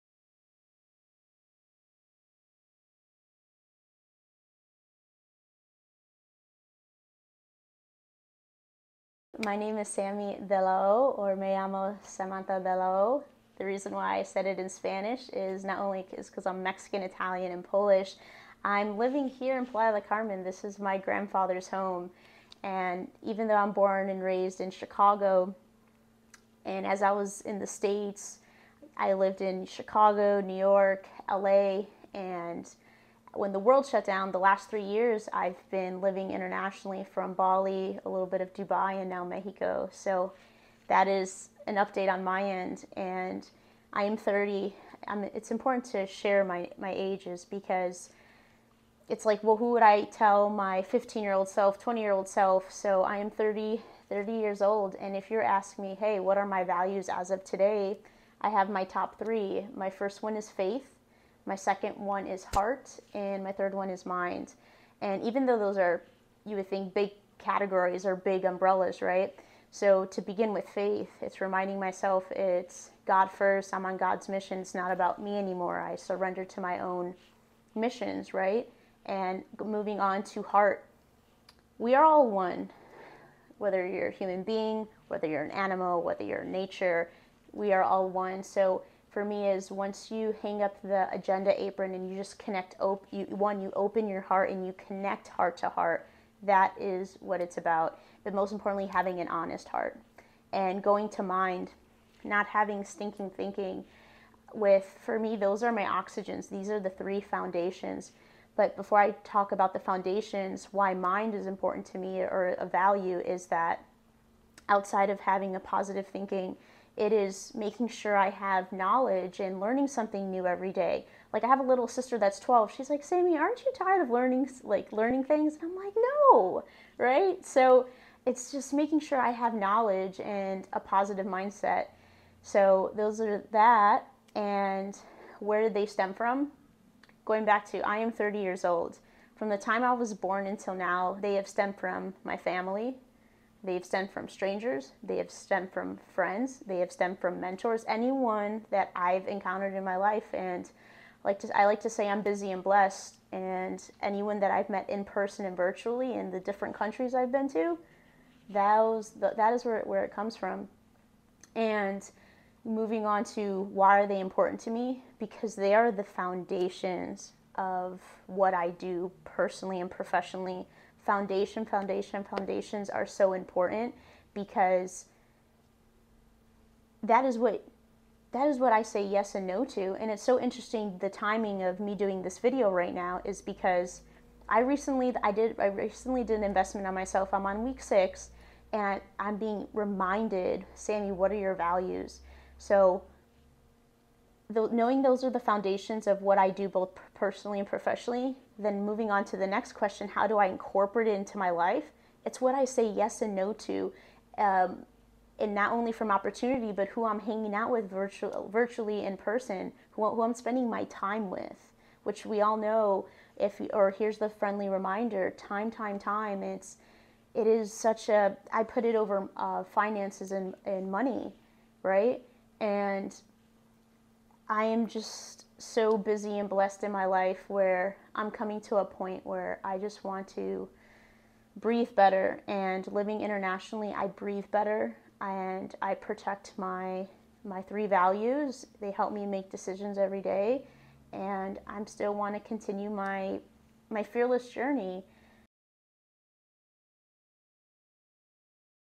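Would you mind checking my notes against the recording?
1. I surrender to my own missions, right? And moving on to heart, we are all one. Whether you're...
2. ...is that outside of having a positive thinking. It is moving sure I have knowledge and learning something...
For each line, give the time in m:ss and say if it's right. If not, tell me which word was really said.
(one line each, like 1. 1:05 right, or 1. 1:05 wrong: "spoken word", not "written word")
1. 1:15 right
2. 1:53 wrong: "making", not "moving".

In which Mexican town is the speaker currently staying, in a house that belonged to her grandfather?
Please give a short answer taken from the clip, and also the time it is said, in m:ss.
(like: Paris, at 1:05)
Playa del Carmen, at 0:19.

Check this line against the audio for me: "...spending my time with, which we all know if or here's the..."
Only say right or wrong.
right.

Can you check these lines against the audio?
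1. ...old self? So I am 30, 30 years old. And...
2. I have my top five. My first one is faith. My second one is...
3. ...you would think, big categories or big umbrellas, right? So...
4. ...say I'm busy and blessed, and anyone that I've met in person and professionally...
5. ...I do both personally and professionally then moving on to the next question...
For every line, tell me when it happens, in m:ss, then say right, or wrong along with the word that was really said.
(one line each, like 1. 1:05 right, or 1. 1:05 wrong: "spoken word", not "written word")
1. 0:52 right
2. 0:58 wrong: "three", not "five"
3. 1:06 right
4. 2:31 wrong: "virtually", not "professionally"
5. 3:16 right.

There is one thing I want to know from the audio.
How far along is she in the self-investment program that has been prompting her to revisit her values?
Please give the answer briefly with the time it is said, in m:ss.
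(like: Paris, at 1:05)
Week 6, at 3:07.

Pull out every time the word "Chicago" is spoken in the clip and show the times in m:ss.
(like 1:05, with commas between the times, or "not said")
0:24, 0:29.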